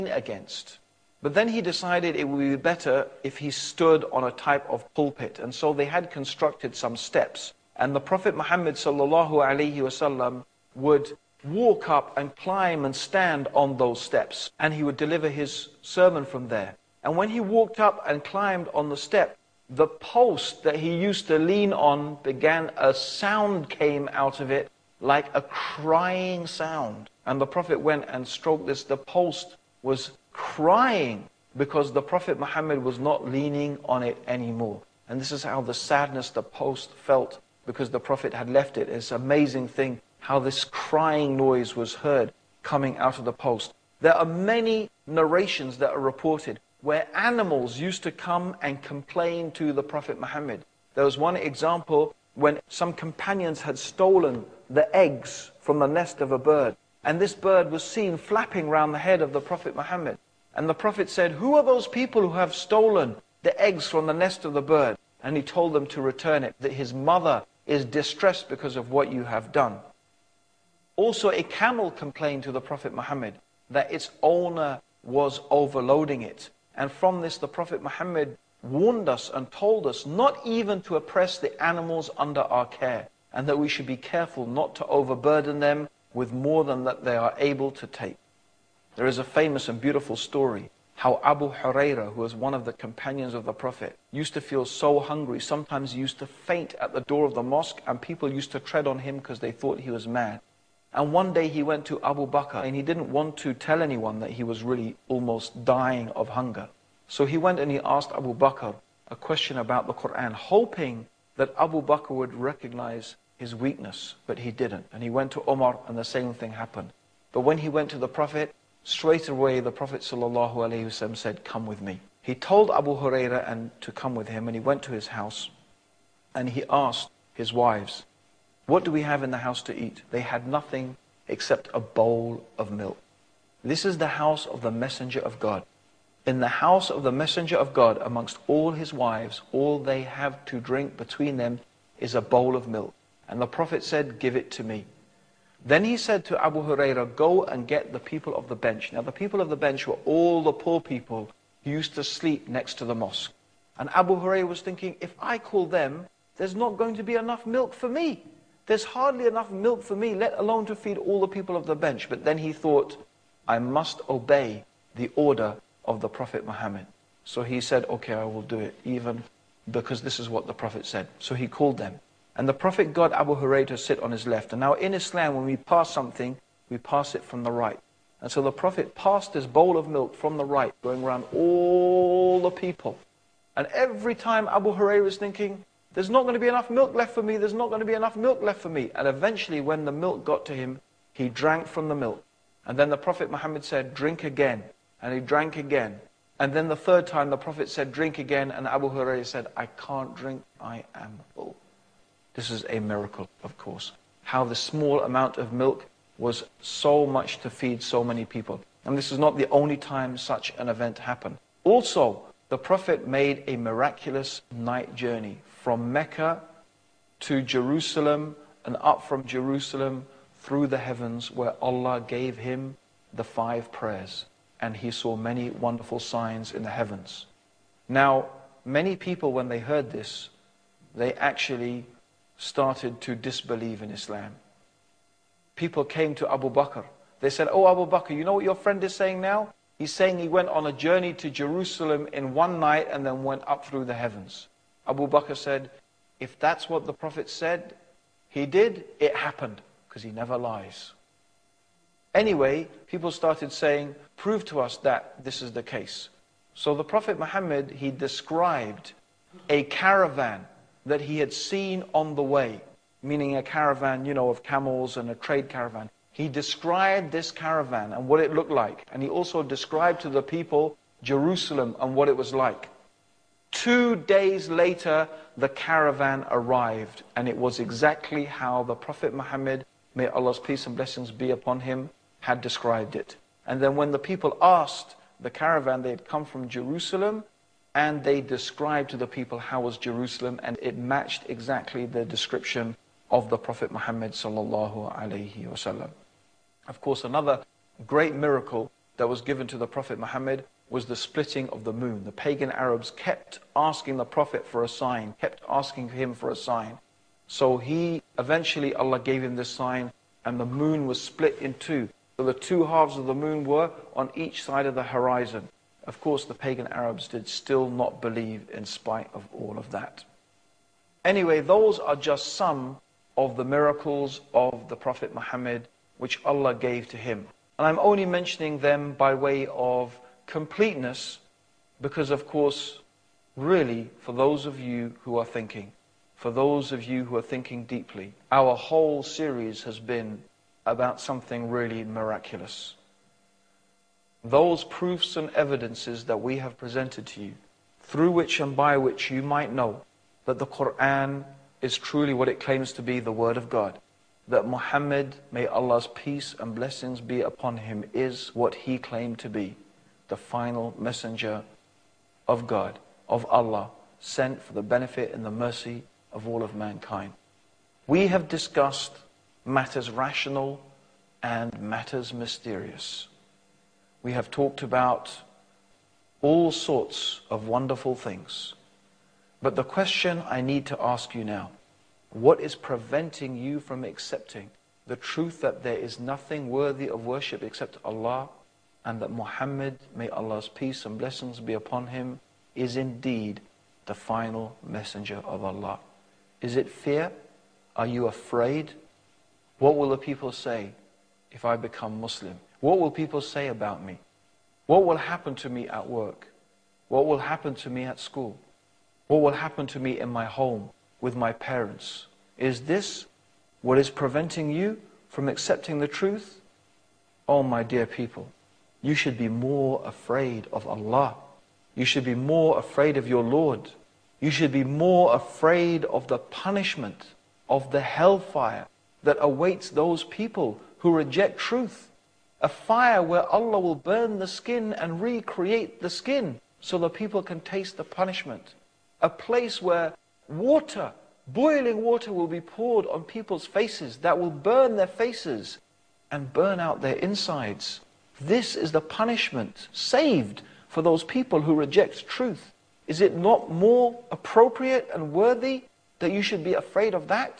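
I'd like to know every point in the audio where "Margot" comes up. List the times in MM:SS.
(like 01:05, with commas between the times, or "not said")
not said.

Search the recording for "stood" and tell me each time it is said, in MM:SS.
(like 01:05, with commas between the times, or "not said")
00:03.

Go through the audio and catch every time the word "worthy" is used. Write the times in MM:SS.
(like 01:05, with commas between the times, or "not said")
06:26, 07:35.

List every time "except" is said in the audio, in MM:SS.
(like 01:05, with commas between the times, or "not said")
02:11, 06:27.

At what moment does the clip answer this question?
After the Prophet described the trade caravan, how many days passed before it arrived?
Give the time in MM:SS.
04:33.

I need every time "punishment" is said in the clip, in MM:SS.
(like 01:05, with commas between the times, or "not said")
07:06, 07:17, 07:28.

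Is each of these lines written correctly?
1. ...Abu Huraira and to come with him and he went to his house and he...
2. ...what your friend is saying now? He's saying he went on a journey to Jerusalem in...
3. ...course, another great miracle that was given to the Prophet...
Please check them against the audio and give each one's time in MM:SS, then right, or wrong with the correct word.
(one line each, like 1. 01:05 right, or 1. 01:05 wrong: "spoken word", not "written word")
1. 02:02 right
2. 03:58 right
3. 04:56 right.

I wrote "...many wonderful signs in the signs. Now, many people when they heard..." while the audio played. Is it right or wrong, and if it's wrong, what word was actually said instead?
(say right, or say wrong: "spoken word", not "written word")
wrong: "heavens", not "signs".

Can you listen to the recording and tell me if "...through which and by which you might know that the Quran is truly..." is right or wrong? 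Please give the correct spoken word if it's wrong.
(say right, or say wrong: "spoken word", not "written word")
right.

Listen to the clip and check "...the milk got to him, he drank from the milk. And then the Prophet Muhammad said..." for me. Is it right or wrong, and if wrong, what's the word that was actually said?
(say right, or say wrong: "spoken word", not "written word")
right.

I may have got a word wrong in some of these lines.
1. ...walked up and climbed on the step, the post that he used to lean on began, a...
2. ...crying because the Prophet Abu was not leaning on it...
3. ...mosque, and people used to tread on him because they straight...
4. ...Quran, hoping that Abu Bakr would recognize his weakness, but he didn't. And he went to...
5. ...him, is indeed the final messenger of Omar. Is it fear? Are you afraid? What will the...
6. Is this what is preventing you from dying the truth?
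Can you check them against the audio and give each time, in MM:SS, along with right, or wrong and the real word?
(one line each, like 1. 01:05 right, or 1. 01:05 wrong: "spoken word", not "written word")
1. 00:17 right
2. 00:30 wrong: "Muhammad", not "Abu"
3. 01:37 wrong: "thought", not "straight"
4. 01:49 right
5. 06:31 wrong: "Allah", not "Omar"
6. 06:52 wrong: "accepting", not "dying".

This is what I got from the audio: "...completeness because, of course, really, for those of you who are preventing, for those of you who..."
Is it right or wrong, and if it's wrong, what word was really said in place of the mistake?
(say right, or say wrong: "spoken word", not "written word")
wrong: "thinking", not "preventing".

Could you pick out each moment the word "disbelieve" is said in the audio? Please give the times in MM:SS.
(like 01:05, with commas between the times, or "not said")
03:53.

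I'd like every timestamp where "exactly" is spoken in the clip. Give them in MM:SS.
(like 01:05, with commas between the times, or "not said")
04:37, 04:51.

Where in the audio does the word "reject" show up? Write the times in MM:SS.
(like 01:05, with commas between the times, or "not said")
07:10, 07:31.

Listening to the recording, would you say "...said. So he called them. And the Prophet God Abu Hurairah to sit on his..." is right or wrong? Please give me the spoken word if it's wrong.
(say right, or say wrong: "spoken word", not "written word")
right.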